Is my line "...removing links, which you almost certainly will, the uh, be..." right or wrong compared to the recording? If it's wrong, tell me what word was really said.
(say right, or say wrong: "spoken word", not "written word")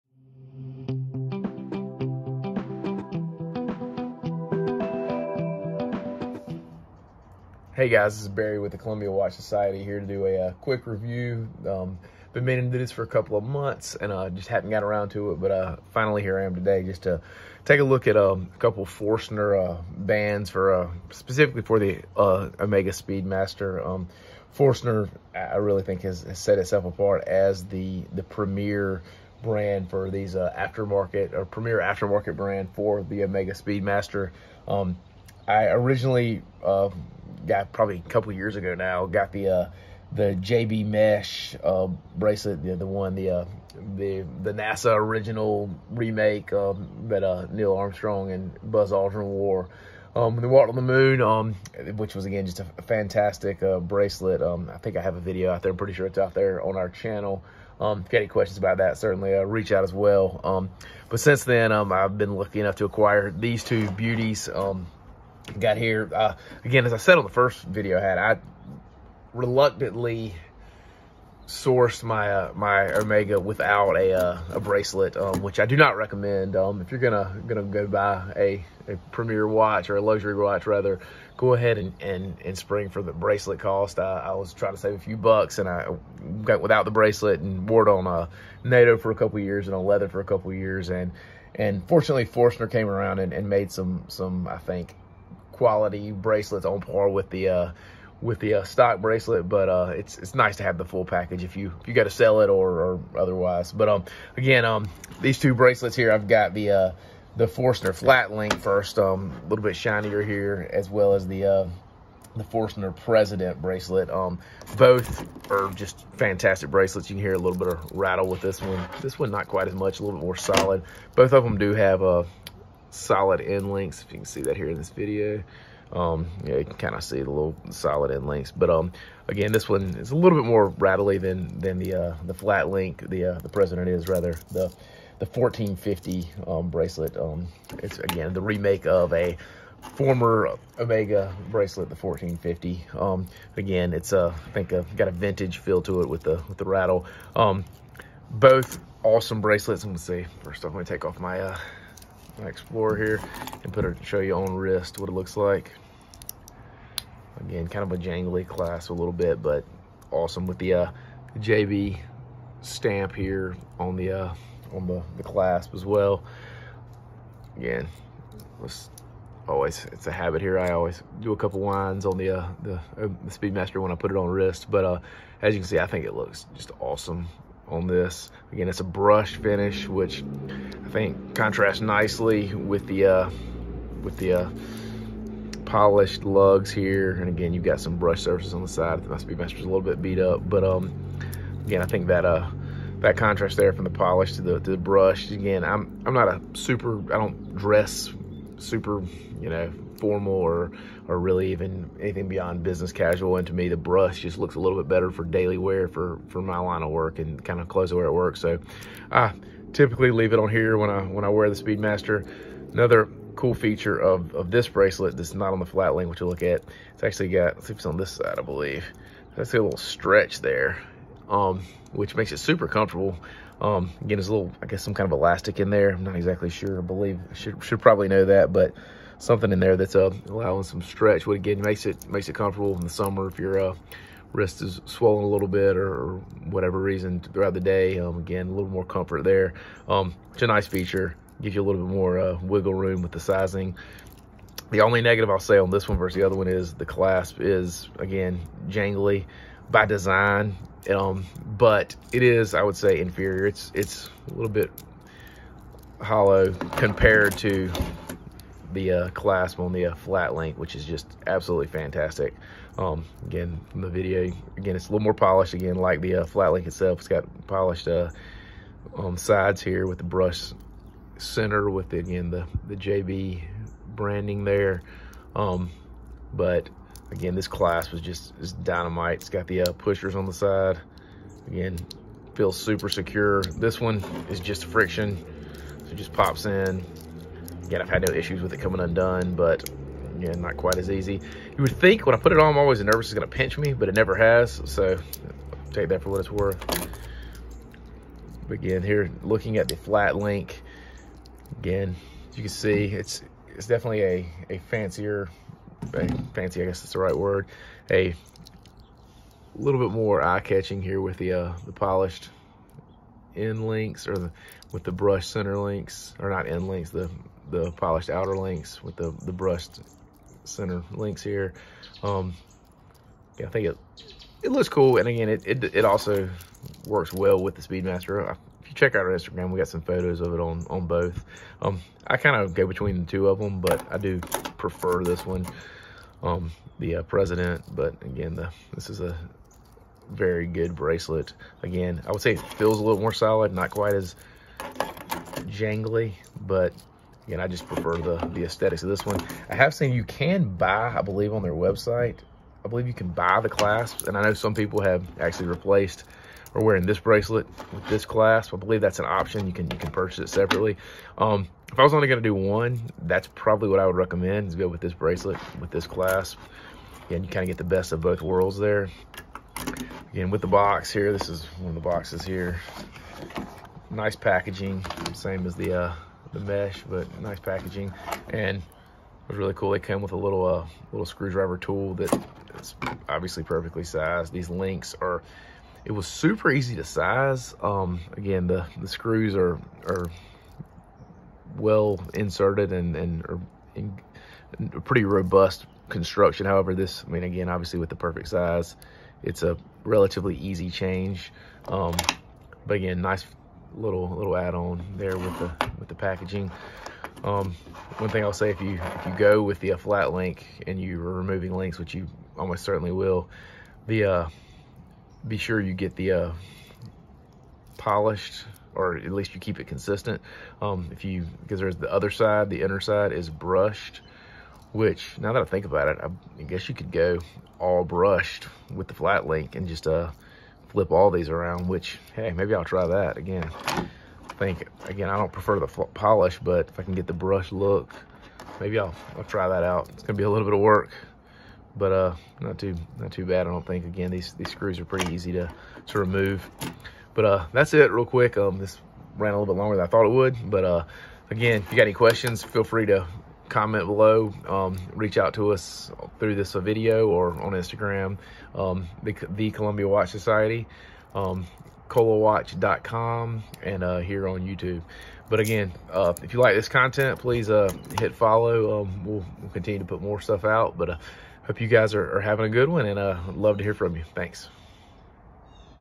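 right.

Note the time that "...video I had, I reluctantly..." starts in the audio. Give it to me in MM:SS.
01:07.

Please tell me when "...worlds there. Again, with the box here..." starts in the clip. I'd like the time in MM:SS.
06:08.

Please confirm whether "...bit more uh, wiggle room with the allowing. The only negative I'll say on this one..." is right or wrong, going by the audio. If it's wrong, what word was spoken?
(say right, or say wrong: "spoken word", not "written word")
wrong: "sizing", not "allowing".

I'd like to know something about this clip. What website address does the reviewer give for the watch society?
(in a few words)
colawatch.com.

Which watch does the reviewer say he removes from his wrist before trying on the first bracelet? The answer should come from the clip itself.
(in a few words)
Explorer.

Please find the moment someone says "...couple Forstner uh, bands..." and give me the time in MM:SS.
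00:18.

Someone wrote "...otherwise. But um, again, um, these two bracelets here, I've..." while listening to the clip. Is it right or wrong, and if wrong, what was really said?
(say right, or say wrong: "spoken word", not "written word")
right.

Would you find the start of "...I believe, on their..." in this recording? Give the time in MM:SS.
05:50.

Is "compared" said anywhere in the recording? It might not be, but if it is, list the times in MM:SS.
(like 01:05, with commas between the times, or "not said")
04:16.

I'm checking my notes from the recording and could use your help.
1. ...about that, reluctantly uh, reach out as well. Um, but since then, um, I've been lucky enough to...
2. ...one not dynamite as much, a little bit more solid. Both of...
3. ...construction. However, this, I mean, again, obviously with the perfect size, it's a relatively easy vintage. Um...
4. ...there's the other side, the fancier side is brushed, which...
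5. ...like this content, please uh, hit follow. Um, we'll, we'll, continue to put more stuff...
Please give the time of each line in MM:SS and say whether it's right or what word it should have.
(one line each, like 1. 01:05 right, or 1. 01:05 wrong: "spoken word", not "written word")
1. 00:58 wrong: "certainly", not "reluctantly"
2. 01:59 wrong: "quite", not "dynamite"
3. 06:35 wrong: "change", not "vintage"
4. 07:01 wrong: "inner", not "fancier"
5. 07:46 right.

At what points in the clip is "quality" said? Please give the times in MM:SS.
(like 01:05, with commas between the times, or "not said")
01:35.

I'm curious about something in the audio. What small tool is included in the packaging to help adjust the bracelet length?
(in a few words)
screwdriver.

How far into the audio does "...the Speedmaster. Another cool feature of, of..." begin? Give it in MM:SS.
03:31.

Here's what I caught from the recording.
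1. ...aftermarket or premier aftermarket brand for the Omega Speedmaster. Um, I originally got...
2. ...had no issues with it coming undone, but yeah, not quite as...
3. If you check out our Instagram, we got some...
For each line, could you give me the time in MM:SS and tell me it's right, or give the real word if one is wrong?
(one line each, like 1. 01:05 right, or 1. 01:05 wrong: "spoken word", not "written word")
1. 00:30 right
2. 04:47 right
3. 05:28 right.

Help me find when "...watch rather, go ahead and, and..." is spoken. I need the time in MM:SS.
01:20.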